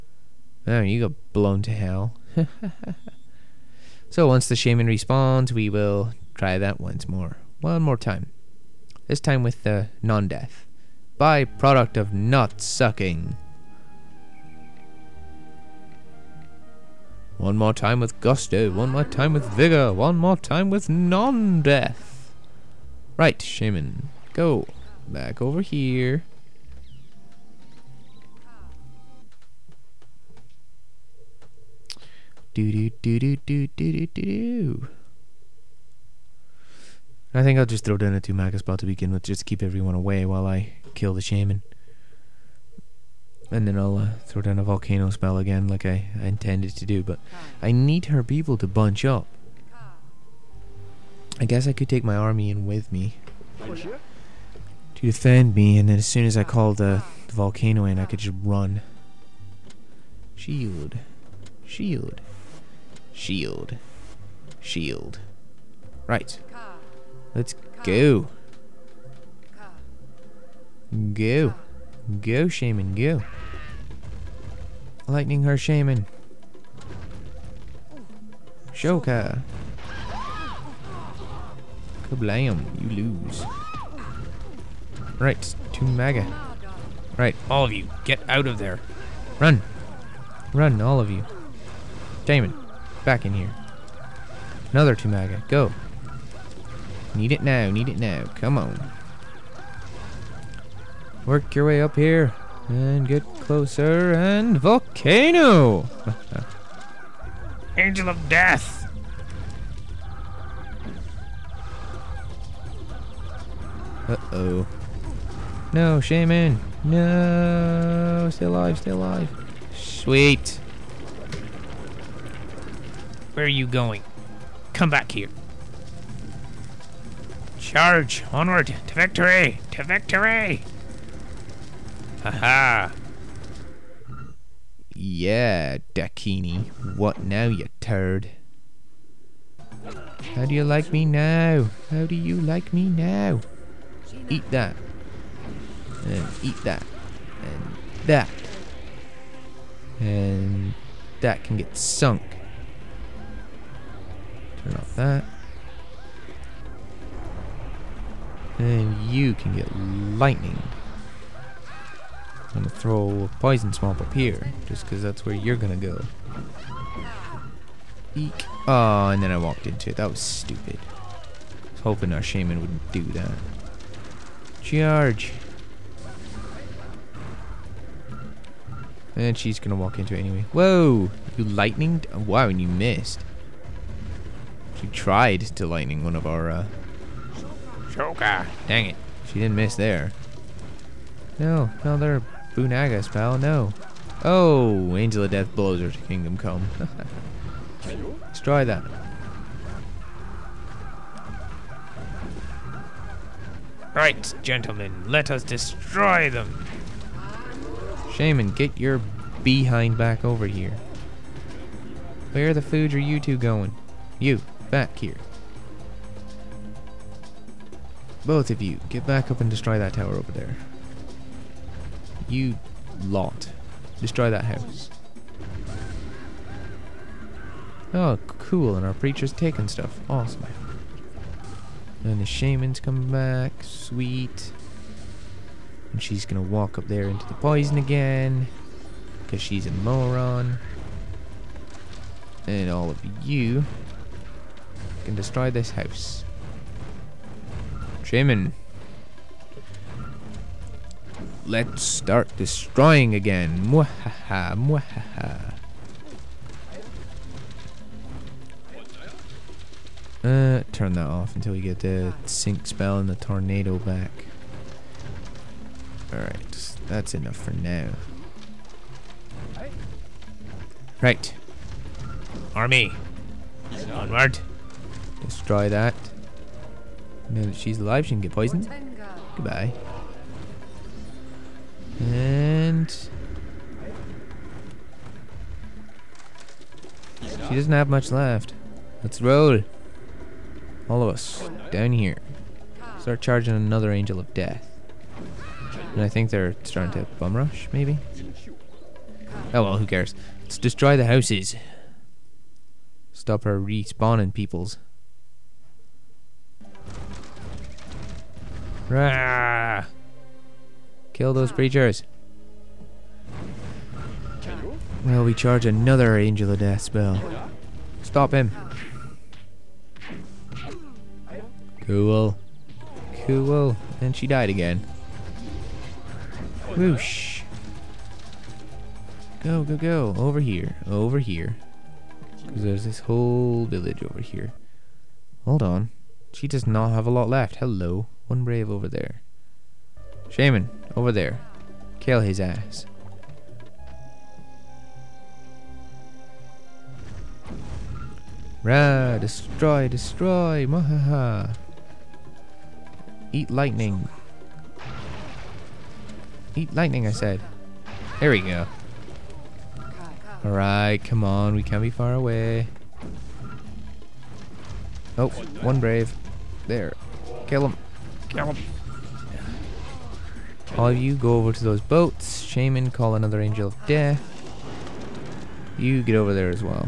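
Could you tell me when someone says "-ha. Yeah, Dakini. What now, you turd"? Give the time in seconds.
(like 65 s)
132 s.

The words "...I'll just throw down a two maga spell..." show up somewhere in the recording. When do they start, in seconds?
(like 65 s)
37 s.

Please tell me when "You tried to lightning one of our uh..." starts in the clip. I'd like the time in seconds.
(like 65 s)
184 s.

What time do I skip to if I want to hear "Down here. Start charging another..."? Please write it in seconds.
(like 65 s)
291 s.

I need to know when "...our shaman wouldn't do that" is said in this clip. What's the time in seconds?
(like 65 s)
172 s.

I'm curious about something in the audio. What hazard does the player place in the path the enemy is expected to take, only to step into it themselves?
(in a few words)
Poison swamp.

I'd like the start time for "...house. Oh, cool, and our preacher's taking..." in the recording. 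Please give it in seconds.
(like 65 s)
224 s.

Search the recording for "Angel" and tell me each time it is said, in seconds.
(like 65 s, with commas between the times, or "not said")
107 s, 194 s, 293 s, 316 s, 373 s.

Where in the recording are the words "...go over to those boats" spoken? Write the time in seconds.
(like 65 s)
371 s.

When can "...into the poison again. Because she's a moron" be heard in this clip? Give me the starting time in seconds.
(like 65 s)
237 s.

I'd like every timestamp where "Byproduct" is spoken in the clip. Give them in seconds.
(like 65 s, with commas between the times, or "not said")
11 s.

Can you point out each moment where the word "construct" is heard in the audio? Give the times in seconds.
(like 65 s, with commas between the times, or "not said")
not said.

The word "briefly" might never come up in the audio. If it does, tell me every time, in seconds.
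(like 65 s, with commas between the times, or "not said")
not said.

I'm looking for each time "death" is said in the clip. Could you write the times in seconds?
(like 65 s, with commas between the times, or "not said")
10 s, 21 s, 108 s, 195 s, 294 s, 316 s, 373 s.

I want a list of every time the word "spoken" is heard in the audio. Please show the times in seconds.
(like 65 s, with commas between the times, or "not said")
not said.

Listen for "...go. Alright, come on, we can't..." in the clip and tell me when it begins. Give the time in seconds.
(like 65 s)
358 s.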